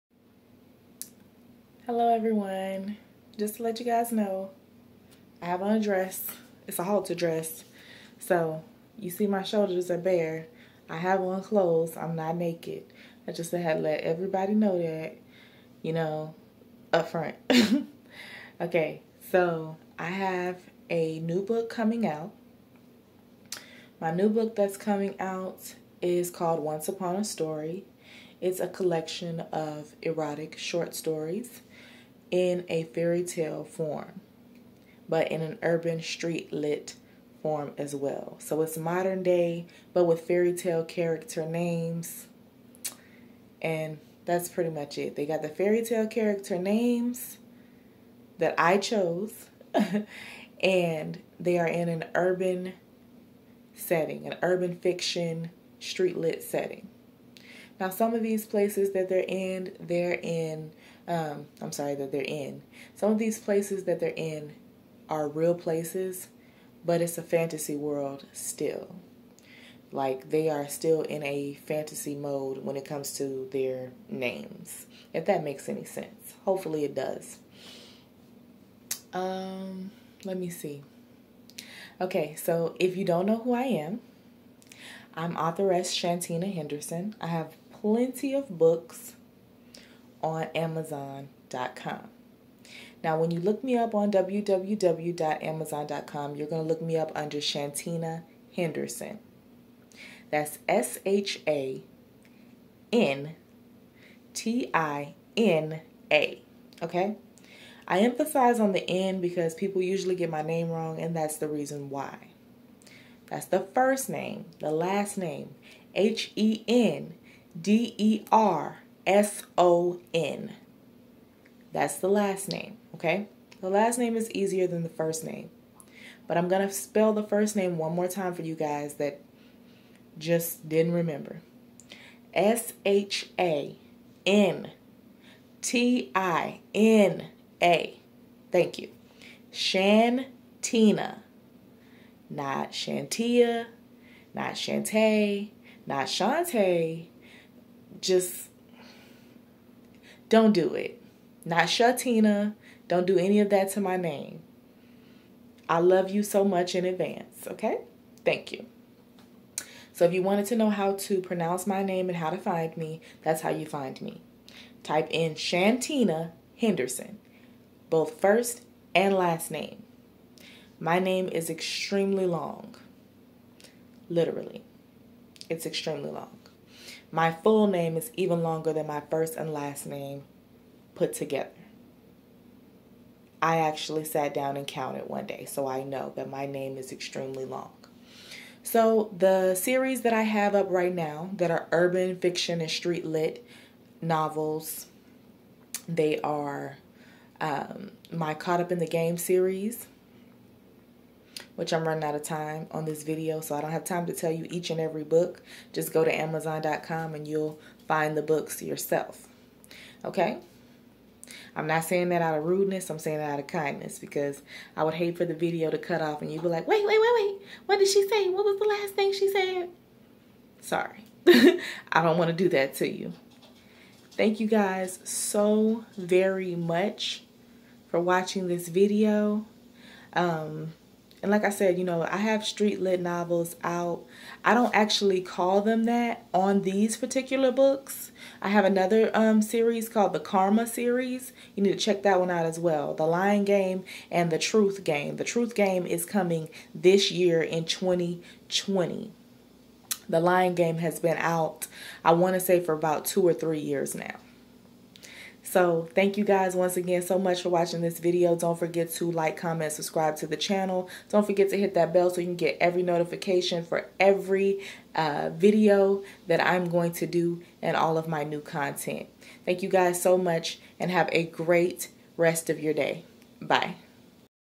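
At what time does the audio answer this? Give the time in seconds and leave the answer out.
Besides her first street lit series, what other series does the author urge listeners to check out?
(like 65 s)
240 s.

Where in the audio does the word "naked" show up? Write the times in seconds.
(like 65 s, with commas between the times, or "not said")
12 s.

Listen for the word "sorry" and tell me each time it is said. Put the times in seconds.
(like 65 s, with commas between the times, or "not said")
61 s, 220 s.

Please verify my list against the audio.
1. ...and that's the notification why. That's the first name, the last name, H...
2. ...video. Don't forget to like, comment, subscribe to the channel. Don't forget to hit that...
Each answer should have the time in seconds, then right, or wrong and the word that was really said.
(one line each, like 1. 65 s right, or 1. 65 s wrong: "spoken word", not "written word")
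1. 110 s wrong: "reason", not "notification"
2. 257 s right.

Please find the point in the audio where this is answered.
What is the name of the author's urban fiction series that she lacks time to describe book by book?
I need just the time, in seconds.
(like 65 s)
198 s.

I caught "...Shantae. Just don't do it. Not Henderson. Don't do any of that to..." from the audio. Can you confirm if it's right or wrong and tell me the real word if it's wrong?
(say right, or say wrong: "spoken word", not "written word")
wrong: "Shatina", not "Henderson".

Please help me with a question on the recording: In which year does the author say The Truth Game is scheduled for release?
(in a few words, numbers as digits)
2020.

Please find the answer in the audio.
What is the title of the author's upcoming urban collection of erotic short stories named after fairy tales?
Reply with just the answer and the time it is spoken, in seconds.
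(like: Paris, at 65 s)
Once Upon a Story, at 26 s.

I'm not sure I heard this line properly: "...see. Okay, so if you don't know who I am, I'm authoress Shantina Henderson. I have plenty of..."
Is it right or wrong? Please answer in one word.
right.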